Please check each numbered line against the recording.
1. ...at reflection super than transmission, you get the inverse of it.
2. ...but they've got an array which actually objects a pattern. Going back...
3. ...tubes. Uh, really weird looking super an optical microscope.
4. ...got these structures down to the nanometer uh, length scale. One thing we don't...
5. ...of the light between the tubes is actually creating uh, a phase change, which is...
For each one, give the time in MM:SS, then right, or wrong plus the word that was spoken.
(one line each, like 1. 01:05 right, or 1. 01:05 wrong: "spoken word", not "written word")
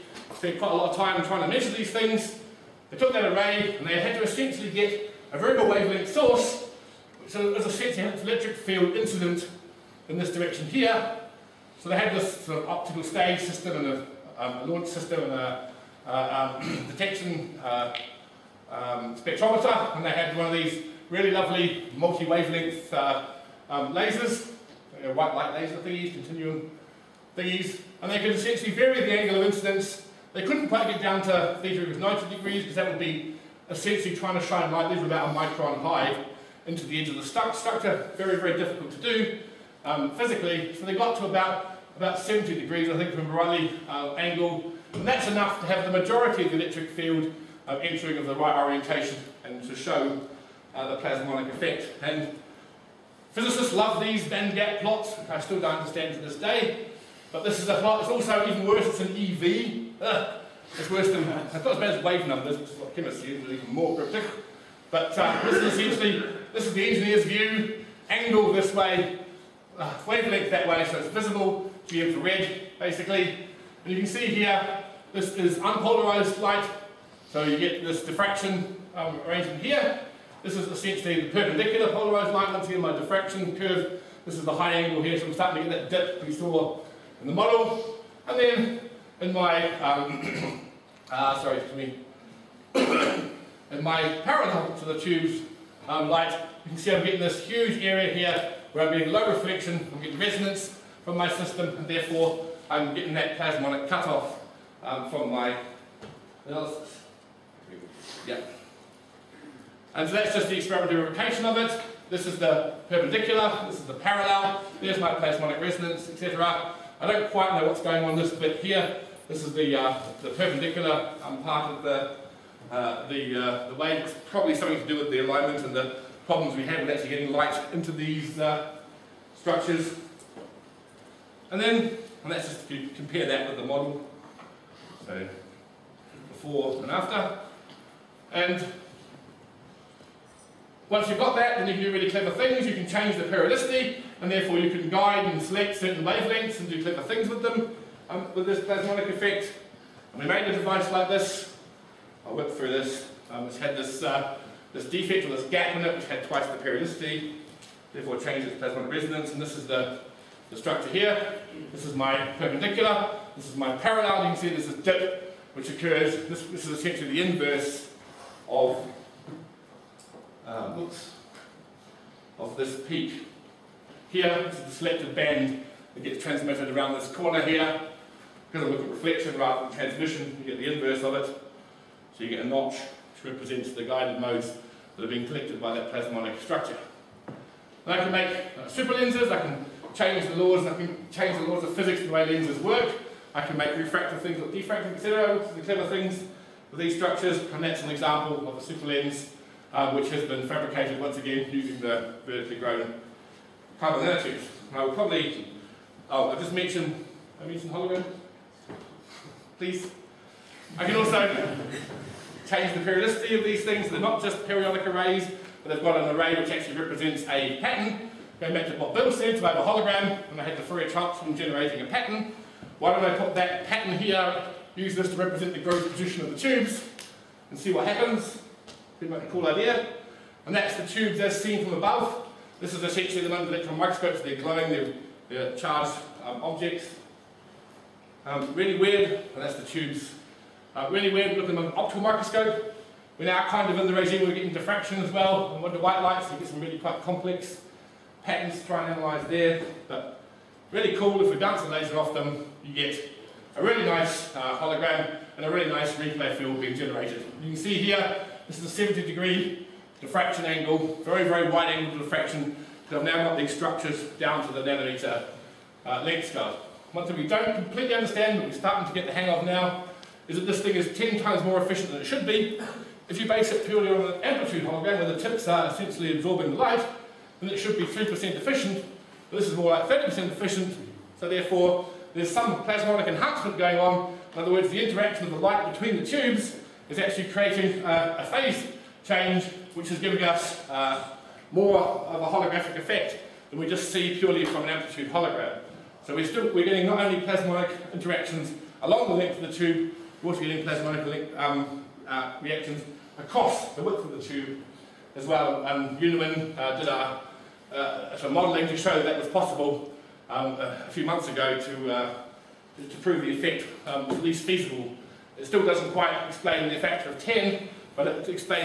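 1. 02:58 wrong: "rather", not "super"
2. 03:35 wrong: "represents", not "objects"
3. 03:59 wrong: "under", not "super"
4. 04:23 right
5. 04:45 right.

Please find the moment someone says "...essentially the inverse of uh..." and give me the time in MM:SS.
02:46.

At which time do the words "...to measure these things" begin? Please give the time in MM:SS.
00:01.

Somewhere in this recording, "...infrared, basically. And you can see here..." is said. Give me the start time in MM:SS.
01:12.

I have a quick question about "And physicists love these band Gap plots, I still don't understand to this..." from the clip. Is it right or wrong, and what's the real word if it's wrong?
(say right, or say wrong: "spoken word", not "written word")
right.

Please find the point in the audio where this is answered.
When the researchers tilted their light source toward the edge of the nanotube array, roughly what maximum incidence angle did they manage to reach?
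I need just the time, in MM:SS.
00:41.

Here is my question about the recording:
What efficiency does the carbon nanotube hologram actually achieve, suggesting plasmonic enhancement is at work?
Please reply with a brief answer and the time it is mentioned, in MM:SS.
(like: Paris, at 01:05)
30%, at 04:39.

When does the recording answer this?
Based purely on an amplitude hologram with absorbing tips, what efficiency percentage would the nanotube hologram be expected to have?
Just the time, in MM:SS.
04:37.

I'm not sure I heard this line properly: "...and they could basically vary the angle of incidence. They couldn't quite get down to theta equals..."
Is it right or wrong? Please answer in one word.
wrong.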